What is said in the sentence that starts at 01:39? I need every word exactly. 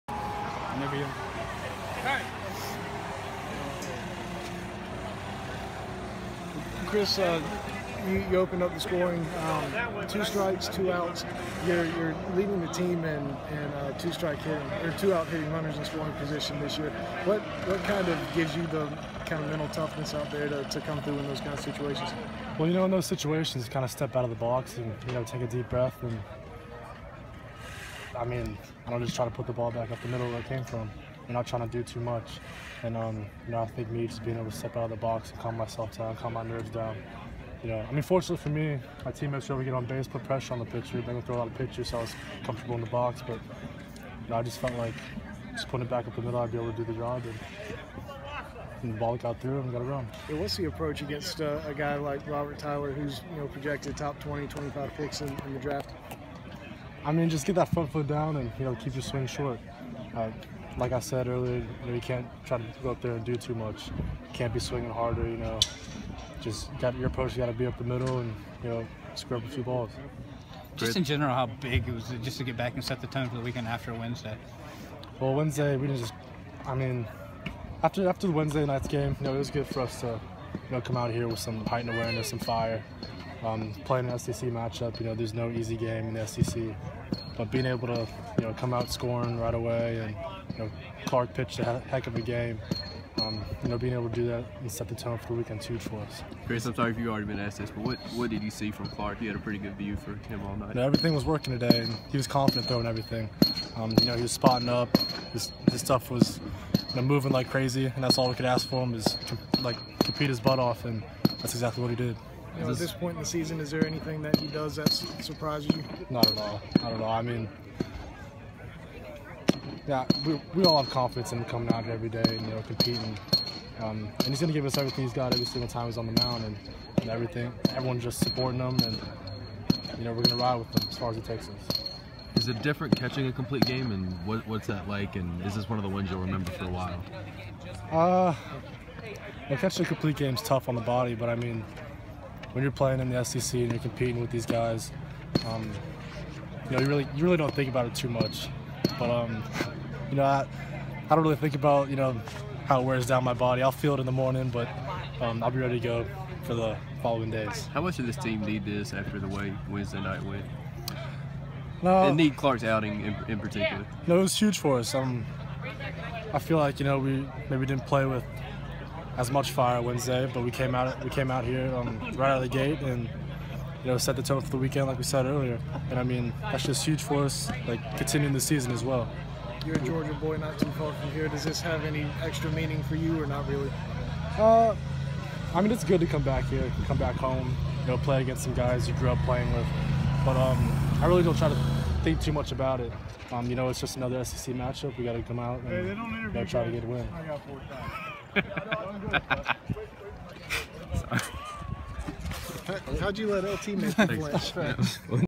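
You had a pretty good view for him all night.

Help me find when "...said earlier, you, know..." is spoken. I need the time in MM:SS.
01:00.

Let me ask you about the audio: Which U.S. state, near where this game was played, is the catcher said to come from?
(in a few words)
Georgia.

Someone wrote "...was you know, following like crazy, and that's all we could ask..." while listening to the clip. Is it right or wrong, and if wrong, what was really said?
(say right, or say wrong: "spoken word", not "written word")
wrong: "moving", not "following".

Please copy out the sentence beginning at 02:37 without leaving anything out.
How much did this team need this after the way Wednesday night went?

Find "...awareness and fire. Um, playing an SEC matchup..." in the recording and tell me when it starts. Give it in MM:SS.
01:21.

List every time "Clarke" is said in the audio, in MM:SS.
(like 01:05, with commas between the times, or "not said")
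01:31, 01:38, 02:42.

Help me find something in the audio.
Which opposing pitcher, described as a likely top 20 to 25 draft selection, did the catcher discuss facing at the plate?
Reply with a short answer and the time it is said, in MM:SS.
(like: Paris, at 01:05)
Robert Tyler, at 00:52.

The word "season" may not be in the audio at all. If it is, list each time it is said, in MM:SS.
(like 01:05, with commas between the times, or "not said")
01:53, 02:58.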